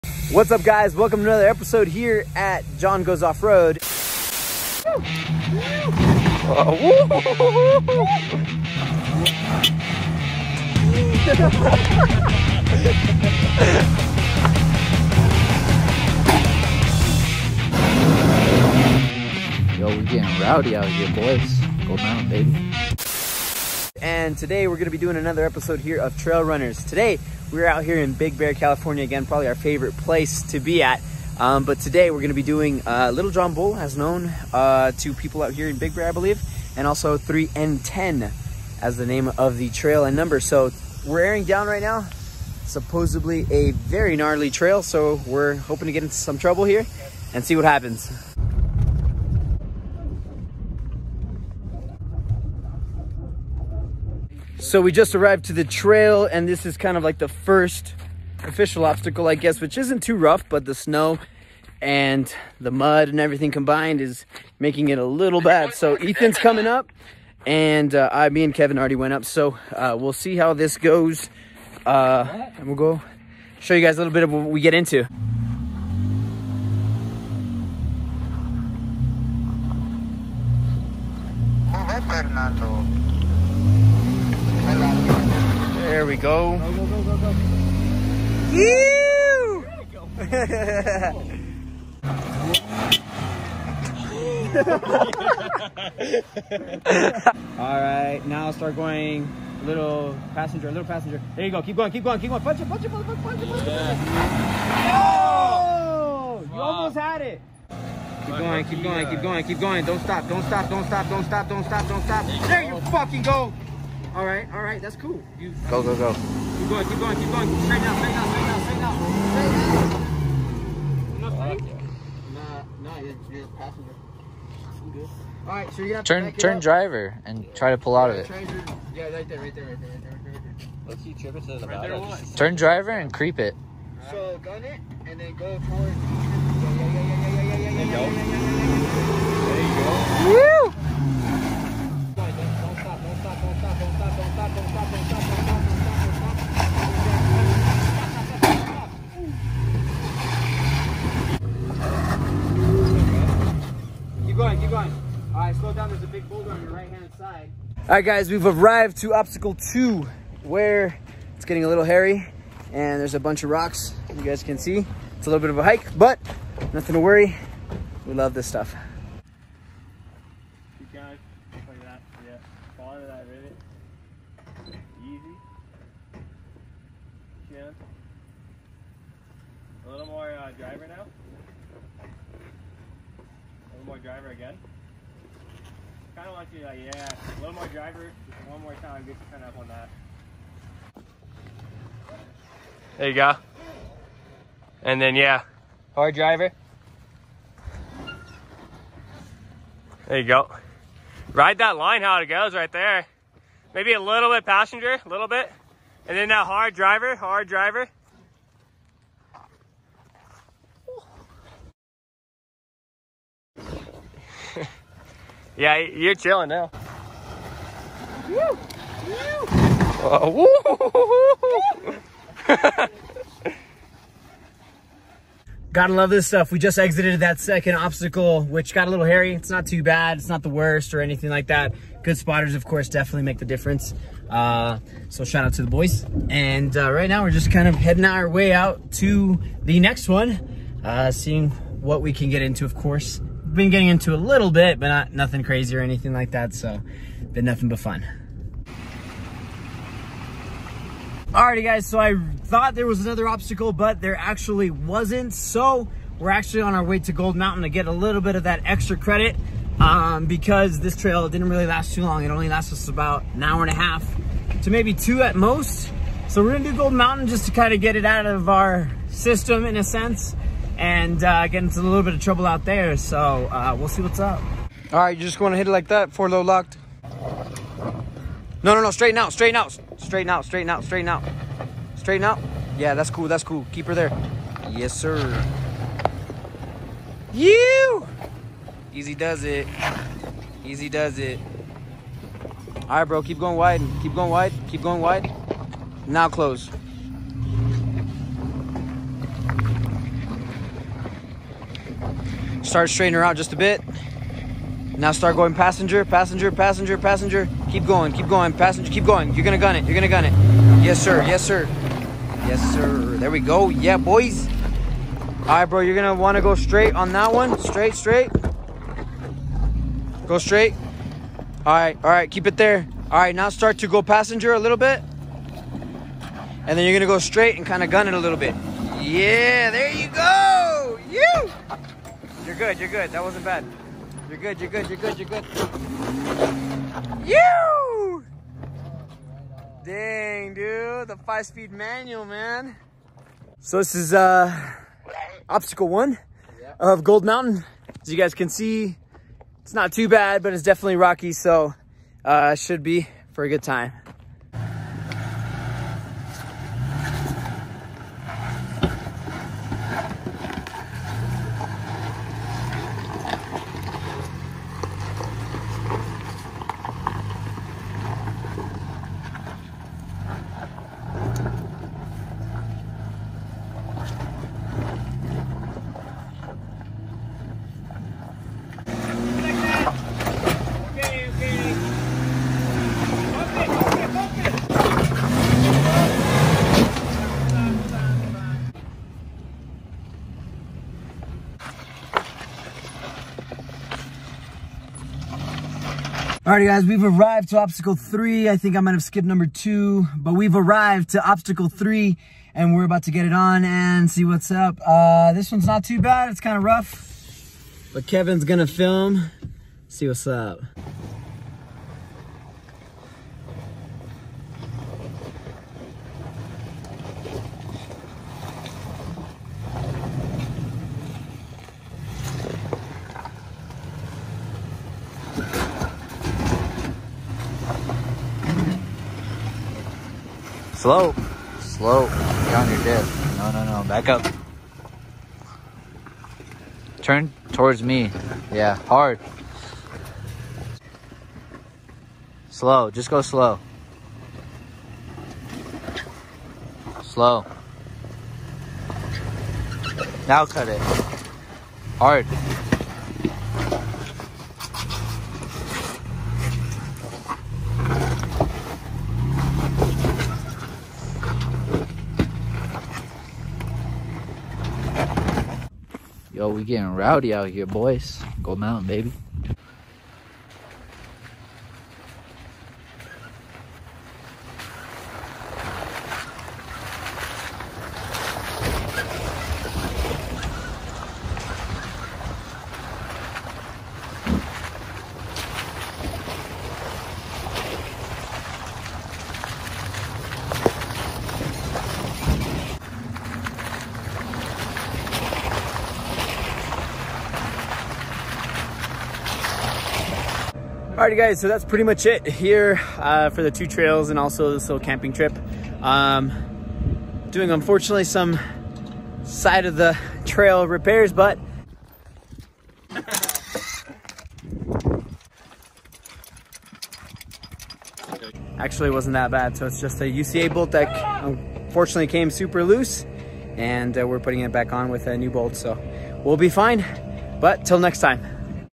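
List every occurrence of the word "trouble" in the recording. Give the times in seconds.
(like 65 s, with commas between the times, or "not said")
46 s, 272 s.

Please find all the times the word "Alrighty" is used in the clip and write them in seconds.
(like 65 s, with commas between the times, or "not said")
251 s, 396 s, 501 s.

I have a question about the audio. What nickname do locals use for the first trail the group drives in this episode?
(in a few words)
Little John Bull.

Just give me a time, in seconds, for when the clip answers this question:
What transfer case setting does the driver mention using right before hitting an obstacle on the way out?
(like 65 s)
276 s.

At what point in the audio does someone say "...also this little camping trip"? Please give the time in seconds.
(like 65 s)
504 s.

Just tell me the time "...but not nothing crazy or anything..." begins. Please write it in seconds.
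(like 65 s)
244 s.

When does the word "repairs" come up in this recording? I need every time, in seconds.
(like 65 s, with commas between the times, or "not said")
510 s.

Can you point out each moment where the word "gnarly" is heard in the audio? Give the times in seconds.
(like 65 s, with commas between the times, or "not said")
44 s.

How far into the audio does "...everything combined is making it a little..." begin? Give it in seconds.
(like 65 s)
63 s.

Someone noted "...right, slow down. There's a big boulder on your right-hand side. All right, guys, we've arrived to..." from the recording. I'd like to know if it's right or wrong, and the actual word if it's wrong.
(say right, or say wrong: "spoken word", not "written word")
right.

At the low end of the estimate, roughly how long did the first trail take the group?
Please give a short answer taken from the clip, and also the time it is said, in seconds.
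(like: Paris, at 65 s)
an hour and a half, at 262 s.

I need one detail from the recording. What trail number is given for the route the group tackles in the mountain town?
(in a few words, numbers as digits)
3N10.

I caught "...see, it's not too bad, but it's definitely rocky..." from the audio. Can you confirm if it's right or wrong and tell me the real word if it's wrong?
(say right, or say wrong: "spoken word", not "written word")
right.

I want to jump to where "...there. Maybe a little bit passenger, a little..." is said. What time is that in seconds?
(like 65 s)
202 s.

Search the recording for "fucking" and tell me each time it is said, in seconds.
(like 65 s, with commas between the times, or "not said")
112 s.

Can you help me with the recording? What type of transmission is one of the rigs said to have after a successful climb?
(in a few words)
five-speed manual.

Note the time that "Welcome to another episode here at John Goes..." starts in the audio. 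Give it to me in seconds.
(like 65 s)
0 s.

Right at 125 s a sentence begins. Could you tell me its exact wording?
All right, so you have turn, to turn up.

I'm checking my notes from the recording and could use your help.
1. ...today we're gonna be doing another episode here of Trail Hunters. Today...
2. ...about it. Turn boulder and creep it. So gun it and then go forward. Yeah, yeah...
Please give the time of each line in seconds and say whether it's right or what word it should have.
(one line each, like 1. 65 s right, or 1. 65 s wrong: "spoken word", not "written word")
1. 24 s right
2. 131 s wrong: "driver", not "boulder".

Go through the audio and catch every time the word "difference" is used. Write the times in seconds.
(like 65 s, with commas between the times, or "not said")
233 s.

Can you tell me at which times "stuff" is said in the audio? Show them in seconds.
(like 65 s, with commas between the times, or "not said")
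168 s, 226 s.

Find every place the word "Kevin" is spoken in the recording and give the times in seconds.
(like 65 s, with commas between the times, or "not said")
68 s, 408 s.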